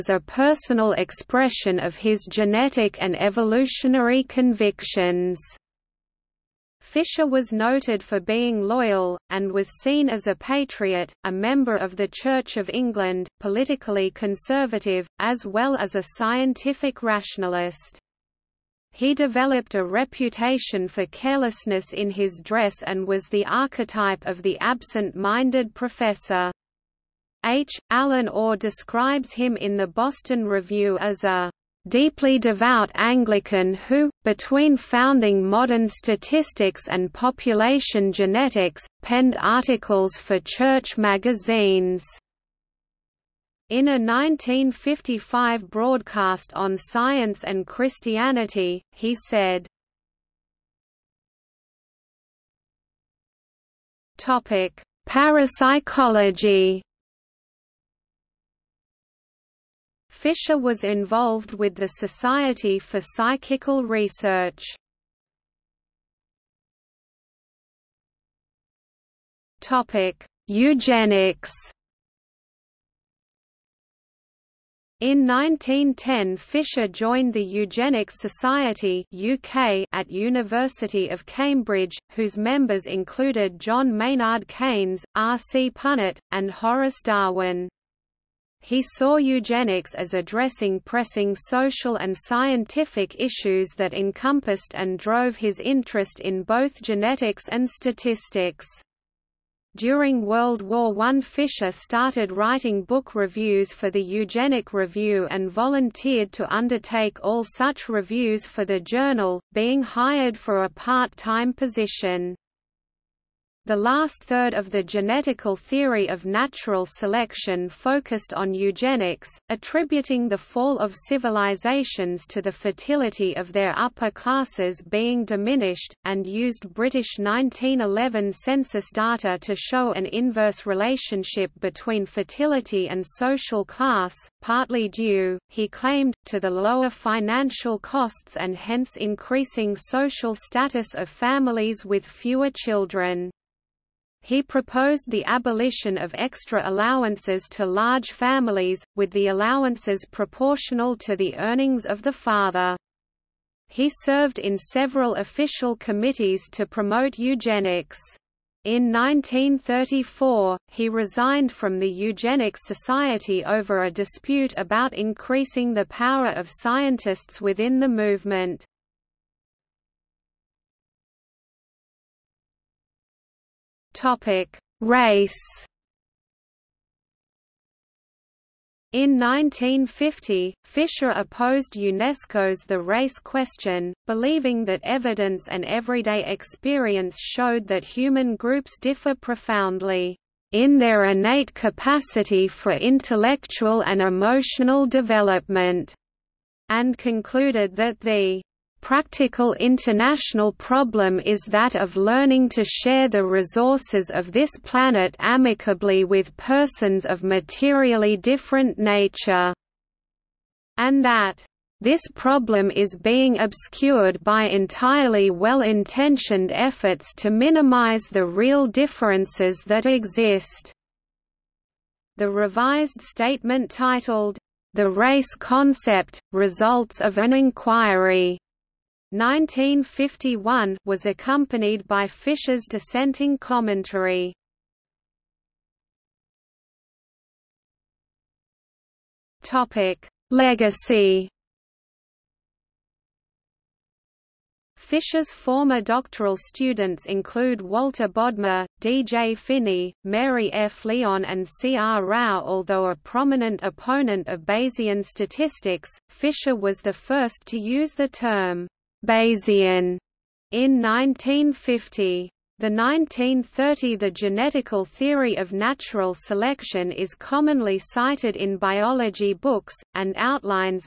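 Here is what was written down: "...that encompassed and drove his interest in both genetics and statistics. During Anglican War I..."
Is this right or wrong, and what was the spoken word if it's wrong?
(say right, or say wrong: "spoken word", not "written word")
wrong: "World", not "Anglican".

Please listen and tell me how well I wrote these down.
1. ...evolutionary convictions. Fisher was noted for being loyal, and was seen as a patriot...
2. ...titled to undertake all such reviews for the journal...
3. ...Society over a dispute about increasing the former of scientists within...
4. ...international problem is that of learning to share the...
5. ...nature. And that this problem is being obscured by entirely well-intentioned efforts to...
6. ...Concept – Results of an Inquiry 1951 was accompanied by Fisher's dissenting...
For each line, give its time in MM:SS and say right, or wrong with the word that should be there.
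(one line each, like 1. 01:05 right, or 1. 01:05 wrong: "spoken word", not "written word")
1. 00:03 right
2. 01:45 wrong: "volunteered", not "titled"
3. 02:42 wrong: "power", not "former"
4. 03:19 right
5. 03:28 right
6. 03:45 right.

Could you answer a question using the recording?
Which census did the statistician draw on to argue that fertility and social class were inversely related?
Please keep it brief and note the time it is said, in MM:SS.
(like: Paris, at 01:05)
British 1911 census, at 02:06.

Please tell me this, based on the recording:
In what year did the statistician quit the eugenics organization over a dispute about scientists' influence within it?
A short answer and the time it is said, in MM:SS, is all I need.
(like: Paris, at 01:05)
1934, at 02:38.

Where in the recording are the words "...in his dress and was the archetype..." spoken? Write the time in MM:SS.
00:21.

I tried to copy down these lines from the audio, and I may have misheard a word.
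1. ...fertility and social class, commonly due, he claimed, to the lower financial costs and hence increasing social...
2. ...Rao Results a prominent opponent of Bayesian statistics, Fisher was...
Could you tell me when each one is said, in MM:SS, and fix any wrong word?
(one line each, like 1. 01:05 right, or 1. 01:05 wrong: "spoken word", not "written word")
1. 02:12 wrong: "partly", not "commonly"
2. 04:12 wrong: "Although", not "Results".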